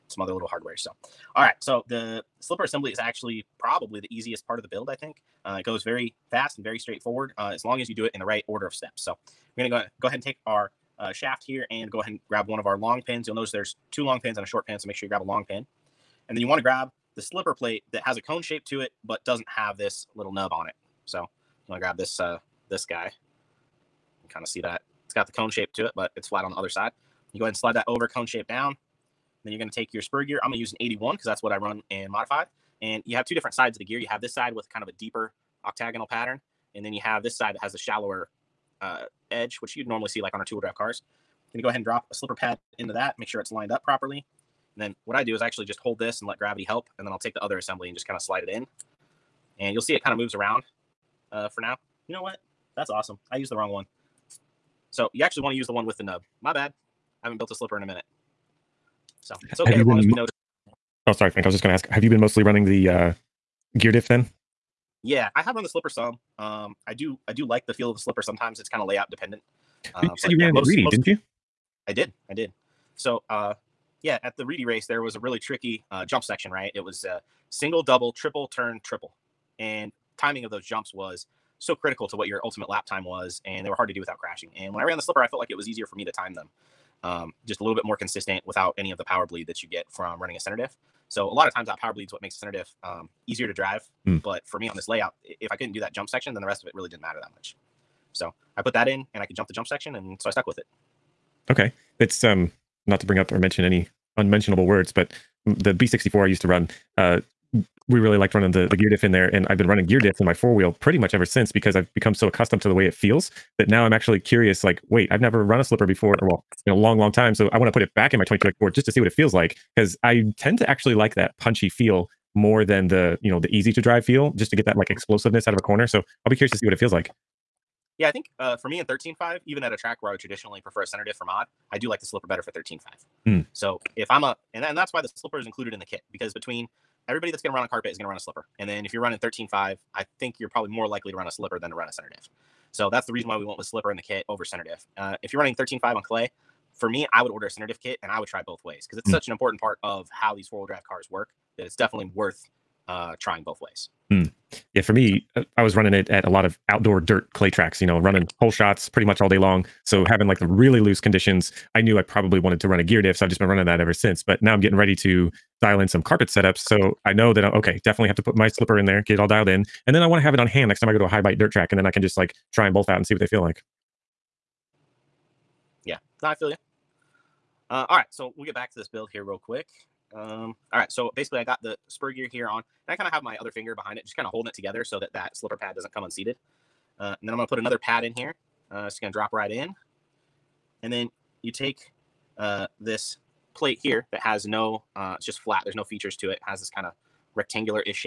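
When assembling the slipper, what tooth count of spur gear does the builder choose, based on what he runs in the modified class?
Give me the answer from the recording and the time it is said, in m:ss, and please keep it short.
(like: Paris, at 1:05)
81, at 0:30.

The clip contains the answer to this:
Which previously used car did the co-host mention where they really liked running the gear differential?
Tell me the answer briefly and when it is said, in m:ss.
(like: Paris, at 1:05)
B64, at 1:45.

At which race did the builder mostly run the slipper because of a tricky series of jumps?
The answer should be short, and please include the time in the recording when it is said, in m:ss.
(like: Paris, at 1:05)
Reedy race, at 1:14.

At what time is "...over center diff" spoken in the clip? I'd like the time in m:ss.
2:24.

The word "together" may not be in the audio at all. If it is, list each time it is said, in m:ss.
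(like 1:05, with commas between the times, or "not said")
3:04.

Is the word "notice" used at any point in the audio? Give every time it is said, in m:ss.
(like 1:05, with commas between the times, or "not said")
0:13, 1:00.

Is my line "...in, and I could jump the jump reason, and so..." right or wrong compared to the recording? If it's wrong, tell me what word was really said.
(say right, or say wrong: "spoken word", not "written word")
wrong: "section", not "reason".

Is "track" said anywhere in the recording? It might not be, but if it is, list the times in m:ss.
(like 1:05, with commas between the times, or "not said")
2:09, 2:37, 2:51.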